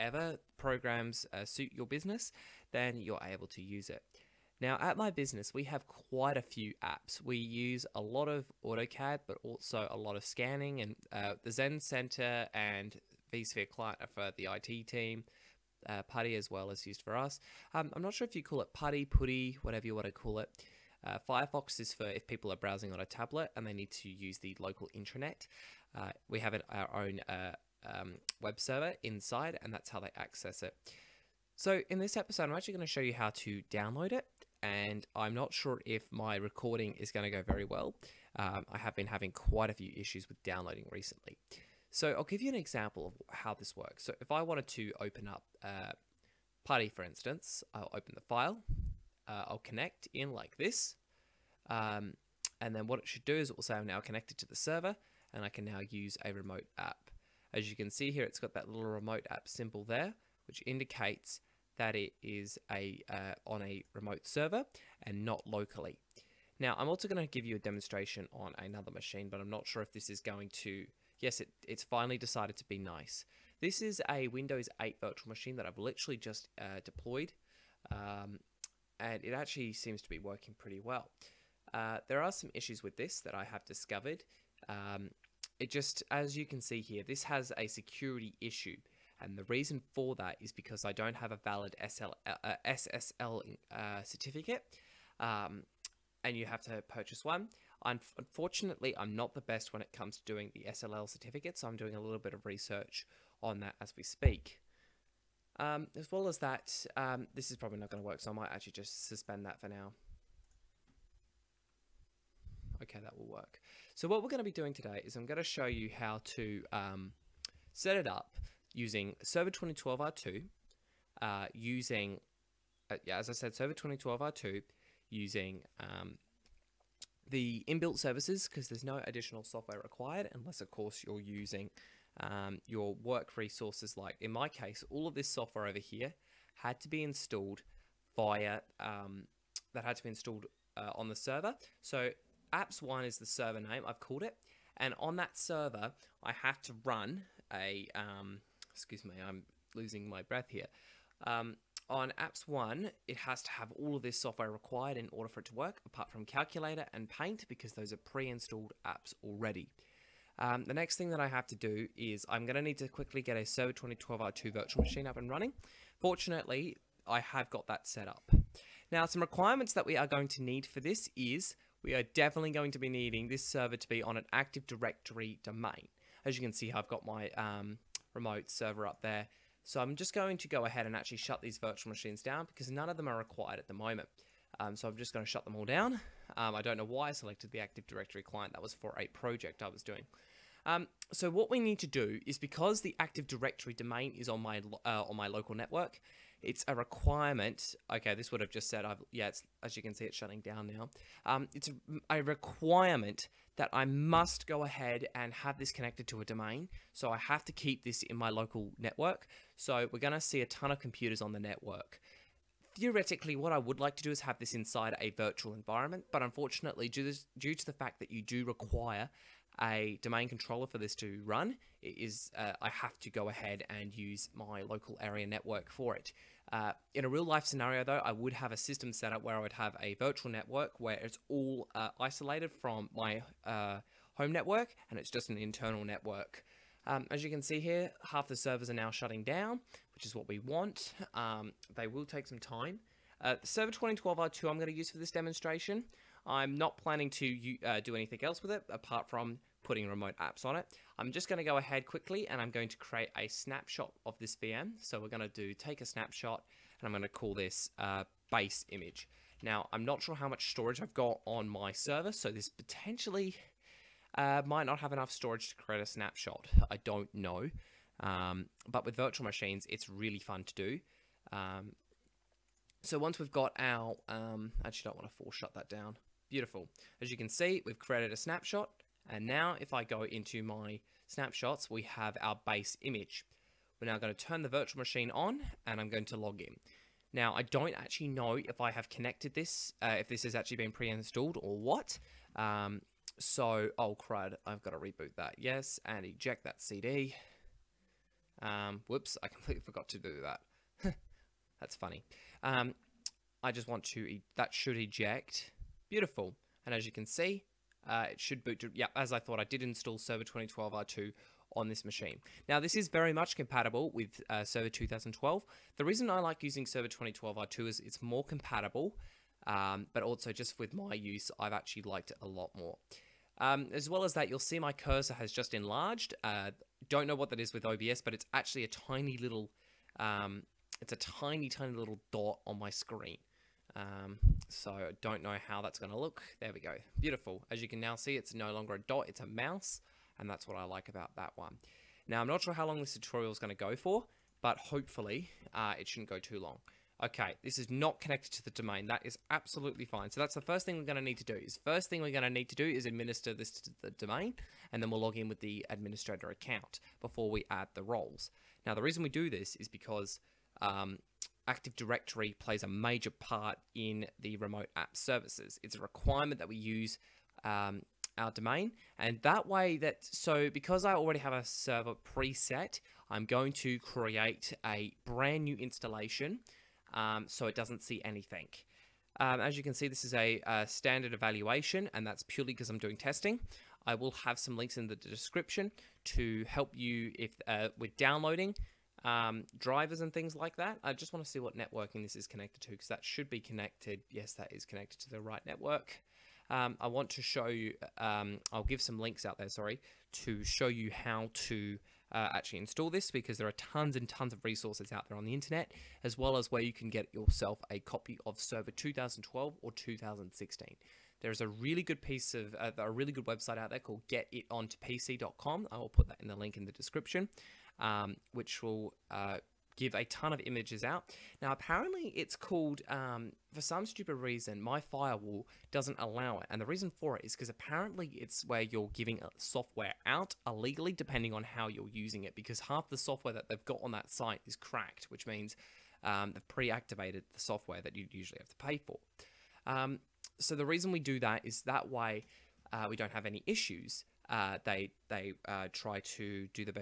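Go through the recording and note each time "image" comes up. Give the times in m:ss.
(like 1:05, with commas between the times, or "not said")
4:18, 4:42, 7:00.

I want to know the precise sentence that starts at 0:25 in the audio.
Uh, we have it, our own uh, um, web server inside, and that's how they access it.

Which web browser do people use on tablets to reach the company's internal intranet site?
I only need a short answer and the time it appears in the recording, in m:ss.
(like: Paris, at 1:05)
Firefox, at 0:21.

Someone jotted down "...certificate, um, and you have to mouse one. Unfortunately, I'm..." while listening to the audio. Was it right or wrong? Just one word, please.
wrong.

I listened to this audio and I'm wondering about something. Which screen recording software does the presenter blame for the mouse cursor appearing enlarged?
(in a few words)
OBS.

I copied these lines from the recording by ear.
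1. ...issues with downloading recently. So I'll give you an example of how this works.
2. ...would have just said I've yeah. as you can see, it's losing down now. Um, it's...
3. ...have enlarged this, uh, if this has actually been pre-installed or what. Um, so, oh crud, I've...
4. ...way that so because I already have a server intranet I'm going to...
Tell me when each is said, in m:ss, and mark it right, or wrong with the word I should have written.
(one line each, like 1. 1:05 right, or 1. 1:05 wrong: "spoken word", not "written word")
1. 0:39 right
2. 3:18 wrong: "shutting", not "losing"
3. 4:48 wrong: "connected", not "enlarged"
4. 6:09 wrong: "preset", not "intranet".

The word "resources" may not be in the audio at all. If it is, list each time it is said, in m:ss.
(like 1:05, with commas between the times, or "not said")
2:13, 6:44.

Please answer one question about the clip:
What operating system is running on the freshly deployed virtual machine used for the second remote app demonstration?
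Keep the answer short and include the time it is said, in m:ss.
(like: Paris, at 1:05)
Windows 8, at 1:14.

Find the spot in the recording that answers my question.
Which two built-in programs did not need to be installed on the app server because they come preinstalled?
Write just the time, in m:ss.
2:36.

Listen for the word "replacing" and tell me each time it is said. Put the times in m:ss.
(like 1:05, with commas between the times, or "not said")
not said.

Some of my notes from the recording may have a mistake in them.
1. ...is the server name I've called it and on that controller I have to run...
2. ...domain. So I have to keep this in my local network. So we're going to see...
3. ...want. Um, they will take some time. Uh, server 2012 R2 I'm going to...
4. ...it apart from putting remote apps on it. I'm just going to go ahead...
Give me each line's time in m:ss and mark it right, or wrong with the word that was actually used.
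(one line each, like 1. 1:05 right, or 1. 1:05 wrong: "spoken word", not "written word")
1. 2:23 wrong: "server", not "controller"
2. 3:26 right
3. 4:00 right
4. 4:08 right.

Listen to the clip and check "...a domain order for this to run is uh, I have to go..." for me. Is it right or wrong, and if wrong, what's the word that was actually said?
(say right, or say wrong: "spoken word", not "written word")
wrong: "controller", not "order".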